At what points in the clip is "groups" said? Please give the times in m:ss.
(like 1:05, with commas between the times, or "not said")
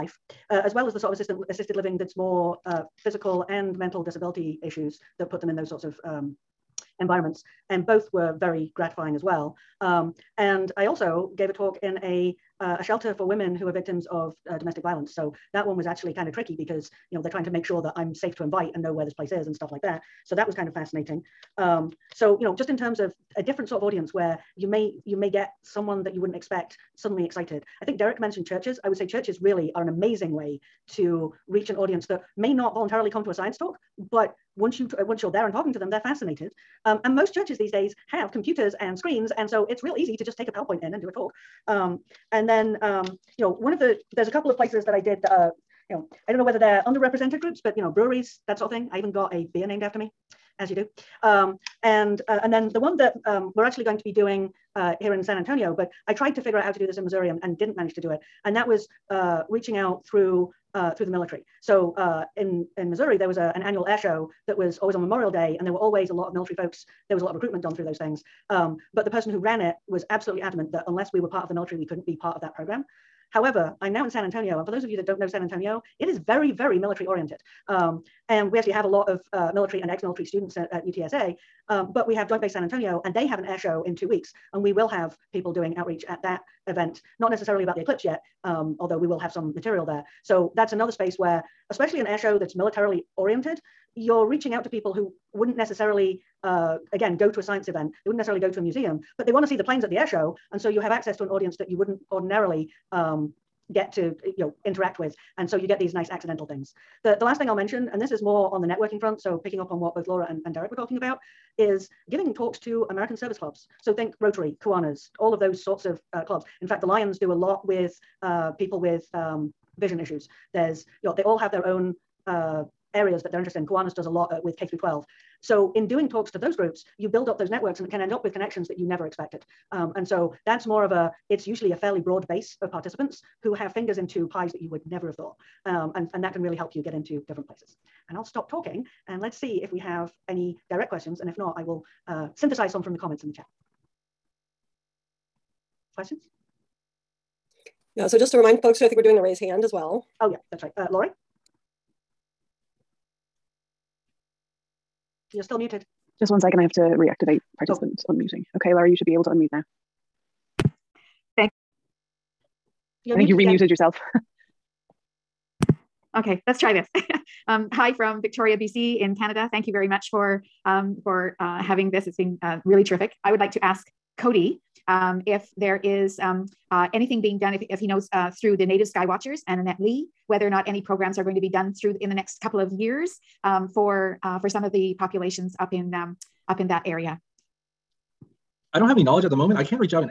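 0:47, 2:06.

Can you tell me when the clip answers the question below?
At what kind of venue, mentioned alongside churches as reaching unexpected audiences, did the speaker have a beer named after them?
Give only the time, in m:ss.
0:47.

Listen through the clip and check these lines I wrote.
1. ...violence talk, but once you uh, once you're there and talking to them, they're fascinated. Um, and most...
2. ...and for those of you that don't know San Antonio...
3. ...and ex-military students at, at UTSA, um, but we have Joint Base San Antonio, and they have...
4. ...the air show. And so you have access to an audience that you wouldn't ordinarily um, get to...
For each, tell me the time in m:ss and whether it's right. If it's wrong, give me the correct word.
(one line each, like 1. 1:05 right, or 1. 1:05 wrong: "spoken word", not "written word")
1. 0:33 wrong: "science", not "violence"
2. 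1:14 right
3. 1:19 right
4. 1:39 right.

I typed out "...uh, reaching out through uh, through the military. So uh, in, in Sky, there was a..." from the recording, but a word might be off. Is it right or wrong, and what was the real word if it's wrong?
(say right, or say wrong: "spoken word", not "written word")
wrong: "Missouri", not "Sky".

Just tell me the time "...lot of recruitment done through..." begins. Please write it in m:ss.
1:07.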